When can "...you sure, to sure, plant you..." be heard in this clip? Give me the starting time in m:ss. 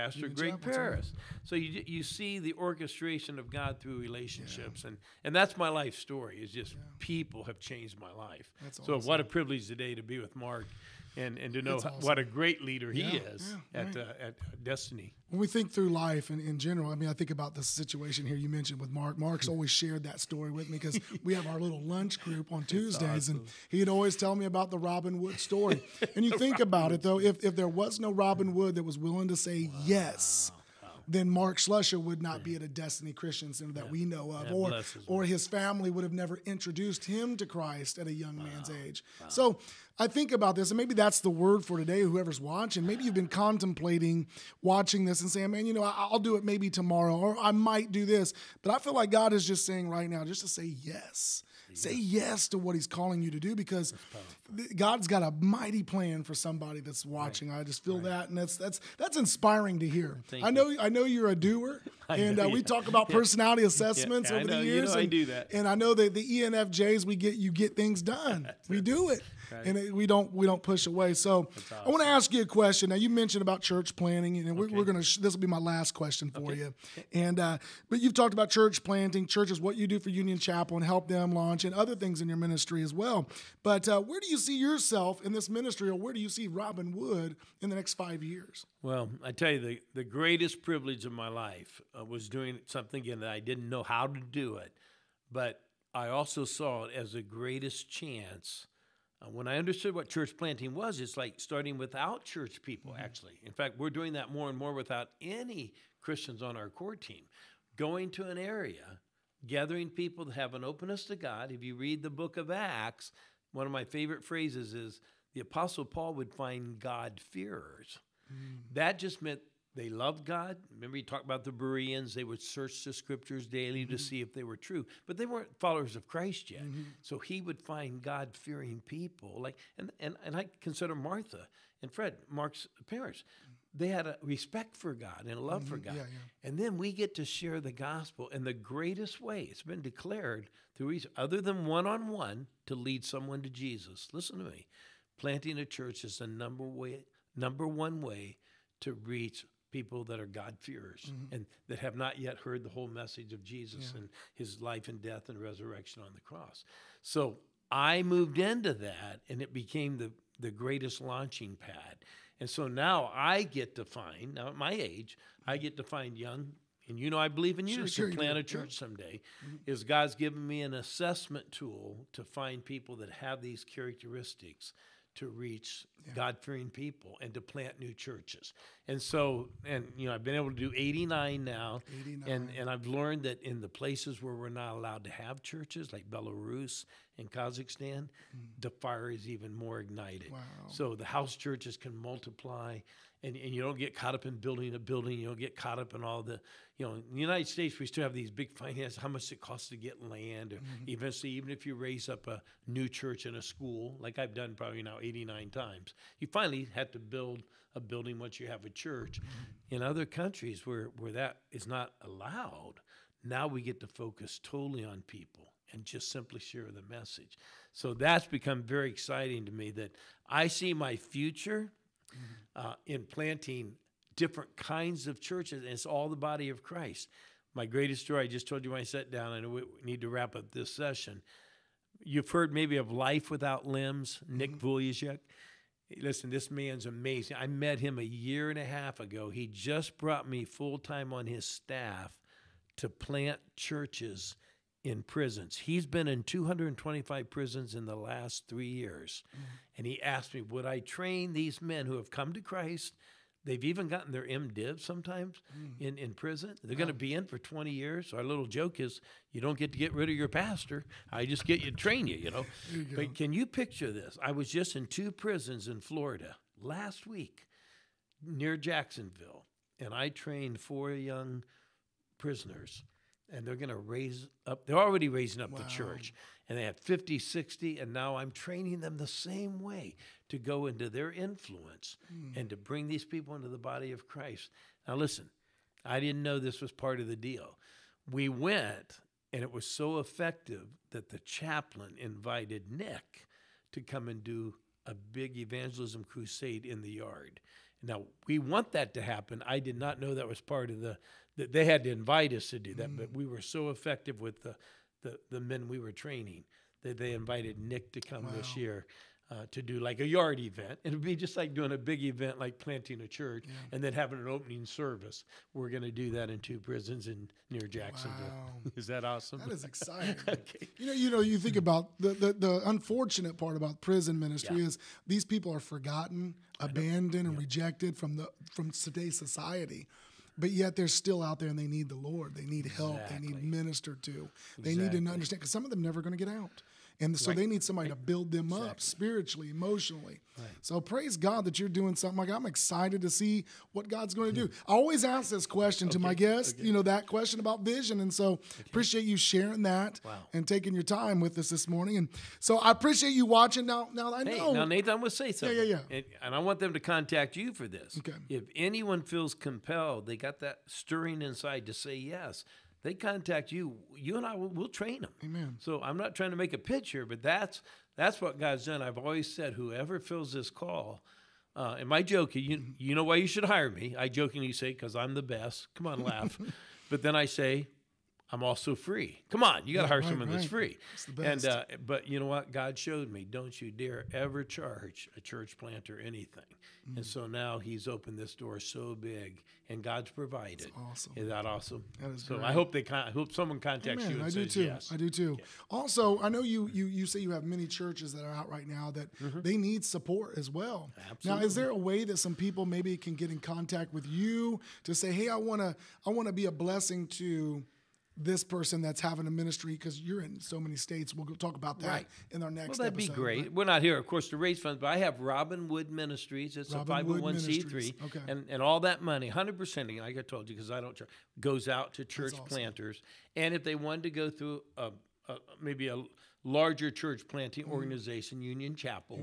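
2:47.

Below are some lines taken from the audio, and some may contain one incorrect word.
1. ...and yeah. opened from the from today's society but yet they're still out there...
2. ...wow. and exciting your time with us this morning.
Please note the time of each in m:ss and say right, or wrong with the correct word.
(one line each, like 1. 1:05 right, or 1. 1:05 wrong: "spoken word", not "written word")
1. 5:27 wrong: "rejected", not "opened"
2. 5:50 wrong: "taking", not "exciting".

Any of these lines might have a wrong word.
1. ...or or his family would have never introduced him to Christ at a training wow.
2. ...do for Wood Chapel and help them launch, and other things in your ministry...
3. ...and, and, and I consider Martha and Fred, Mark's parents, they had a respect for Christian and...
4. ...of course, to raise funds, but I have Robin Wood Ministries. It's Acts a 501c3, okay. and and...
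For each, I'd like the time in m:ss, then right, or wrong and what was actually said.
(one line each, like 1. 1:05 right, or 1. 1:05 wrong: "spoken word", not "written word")
1. 0:34 wrong: "young", not "training"
2. 1:19 wrong: "Union", not "Wood"
3. 2:09 wrong: "God", not "Christian"
4. 6:53 wrong: "Robin", not "Acts".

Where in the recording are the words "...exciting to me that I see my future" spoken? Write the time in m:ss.
3:38.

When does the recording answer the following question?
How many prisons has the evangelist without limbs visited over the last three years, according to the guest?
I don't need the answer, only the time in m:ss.
4:06.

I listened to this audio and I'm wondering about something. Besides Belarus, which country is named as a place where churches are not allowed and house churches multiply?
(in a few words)
Kazakhstan.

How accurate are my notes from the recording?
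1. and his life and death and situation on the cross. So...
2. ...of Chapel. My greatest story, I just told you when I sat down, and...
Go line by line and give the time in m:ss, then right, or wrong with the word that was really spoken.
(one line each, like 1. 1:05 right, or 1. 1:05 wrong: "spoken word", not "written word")
1. 2:34 wrong: "resurrection", not "situation"
2. 3:46 wrong: "Christ", not "Chapel".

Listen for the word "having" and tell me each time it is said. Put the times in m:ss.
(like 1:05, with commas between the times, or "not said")
5:13, 6:48.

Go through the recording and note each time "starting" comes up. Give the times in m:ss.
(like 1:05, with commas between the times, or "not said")
1:41.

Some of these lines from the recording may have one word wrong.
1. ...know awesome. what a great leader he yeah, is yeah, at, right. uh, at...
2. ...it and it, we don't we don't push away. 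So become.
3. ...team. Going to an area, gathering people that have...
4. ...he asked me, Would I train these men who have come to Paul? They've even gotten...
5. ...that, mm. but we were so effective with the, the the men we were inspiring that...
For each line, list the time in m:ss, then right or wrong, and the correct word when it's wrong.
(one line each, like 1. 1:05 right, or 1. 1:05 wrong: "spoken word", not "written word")
1. 0:11 right
2. 1:09 wrong: "awesome", not "become"
3. 1:46 right
4. 4:09 wrong: "Christ", not "Paul"
5. 5:02 wrong: "training", not "inspiring".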